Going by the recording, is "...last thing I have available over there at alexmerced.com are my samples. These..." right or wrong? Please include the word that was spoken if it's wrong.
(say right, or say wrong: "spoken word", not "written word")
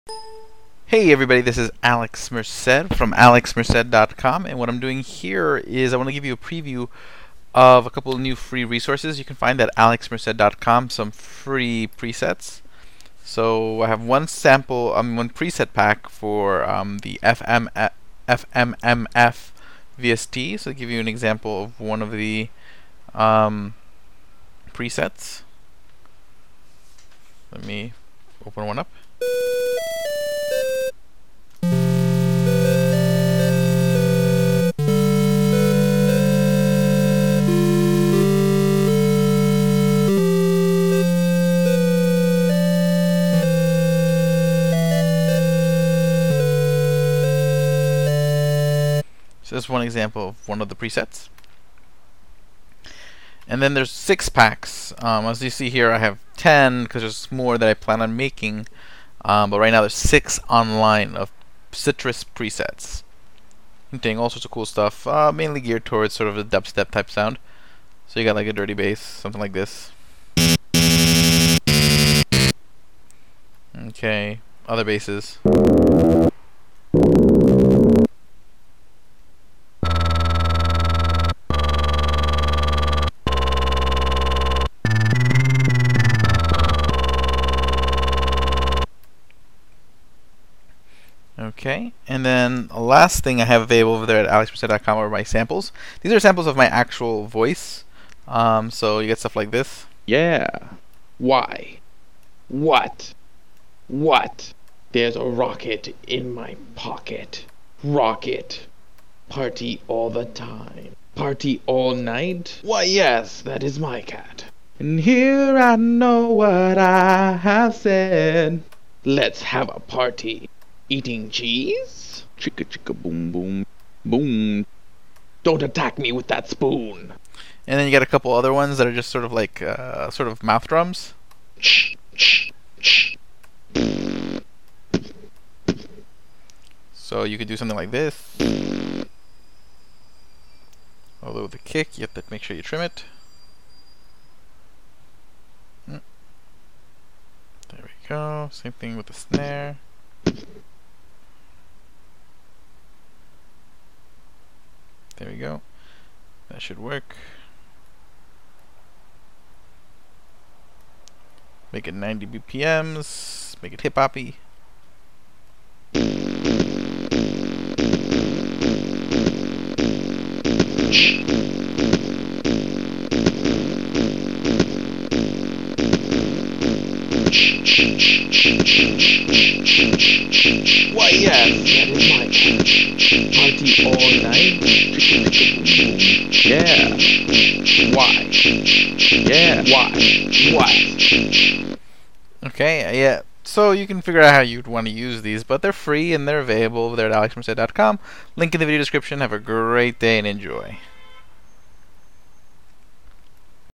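right.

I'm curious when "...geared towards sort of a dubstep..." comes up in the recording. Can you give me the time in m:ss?
1:05.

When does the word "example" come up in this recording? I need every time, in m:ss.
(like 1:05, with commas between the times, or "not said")
0:21, 0:49.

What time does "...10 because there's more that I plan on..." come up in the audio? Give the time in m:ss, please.
0:56.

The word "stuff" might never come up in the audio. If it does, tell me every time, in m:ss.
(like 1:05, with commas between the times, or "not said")
1:04, 1:39.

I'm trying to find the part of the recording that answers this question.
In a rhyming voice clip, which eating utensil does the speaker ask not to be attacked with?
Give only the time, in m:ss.
2:06.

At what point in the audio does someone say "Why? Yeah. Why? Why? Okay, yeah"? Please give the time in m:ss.
3:07.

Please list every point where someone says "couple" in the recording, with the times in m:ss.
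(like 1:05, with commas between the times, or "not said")
0:07, 2:08.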